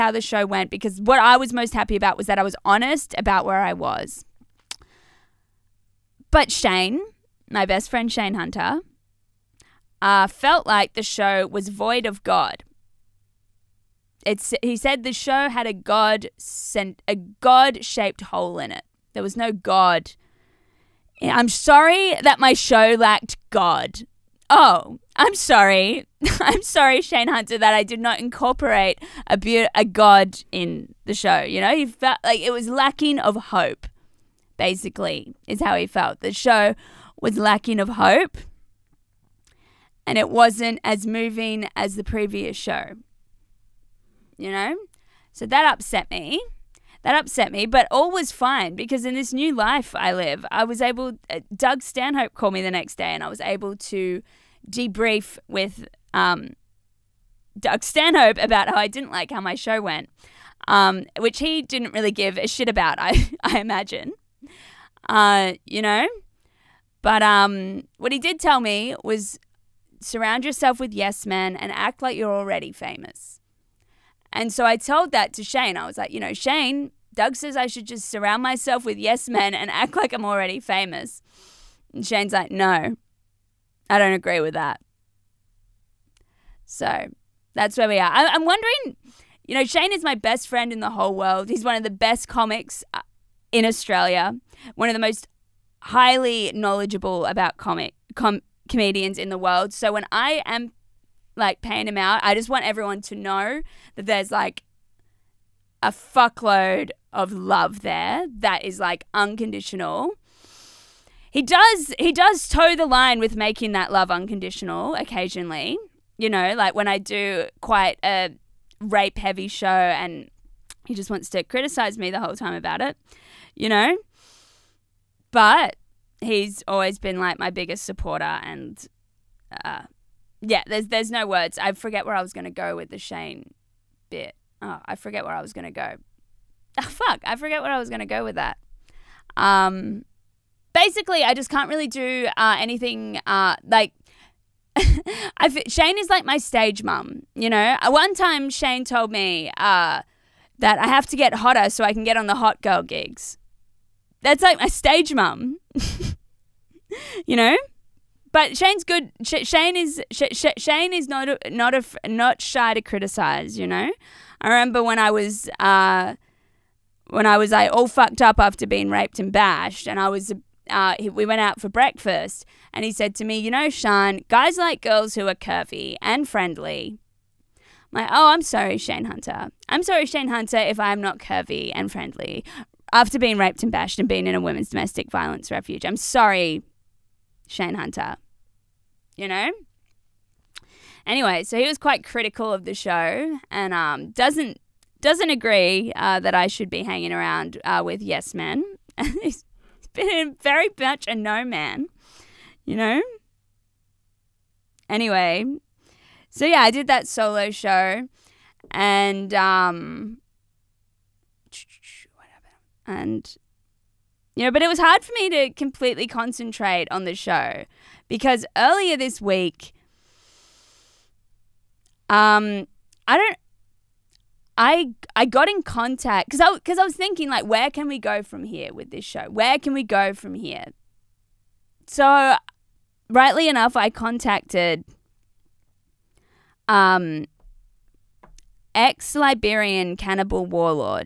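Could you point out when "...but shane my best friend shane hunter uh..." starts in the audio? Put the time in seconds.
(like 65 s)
6 s.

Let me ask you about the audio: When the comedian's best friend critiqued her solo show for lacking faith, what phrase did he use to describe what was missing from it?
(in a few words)
God shaped hole.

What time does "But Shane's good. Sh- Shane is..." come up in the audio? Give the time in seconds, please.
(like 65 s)
158 s.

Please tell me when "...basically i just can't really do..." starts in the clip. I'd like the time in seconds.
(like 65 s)
140 s.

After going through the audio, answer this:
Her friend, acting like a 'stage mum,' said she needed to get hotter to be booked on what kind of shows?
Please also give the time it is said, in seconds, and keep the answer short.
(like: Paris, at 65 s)
hot girl gigs, at 152 s.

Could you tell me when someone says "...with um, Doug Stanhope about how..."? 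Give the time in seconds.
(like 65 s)
55 s.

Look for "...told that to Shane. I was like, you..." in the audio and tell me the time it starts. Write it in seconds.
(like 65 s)
74 s.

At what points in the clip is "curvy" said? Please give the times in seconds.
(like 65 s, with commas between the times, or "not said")
175 s, 181 s.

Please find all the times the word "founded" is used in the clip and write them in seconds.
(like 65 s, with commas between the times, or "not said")
not said.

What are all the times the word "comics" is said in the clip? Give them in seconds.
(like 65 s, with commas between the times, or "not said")
92 s, 97 s.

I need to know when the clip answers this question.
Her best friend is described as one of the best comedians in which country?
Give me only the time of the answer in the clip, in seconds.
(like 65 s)
93 s.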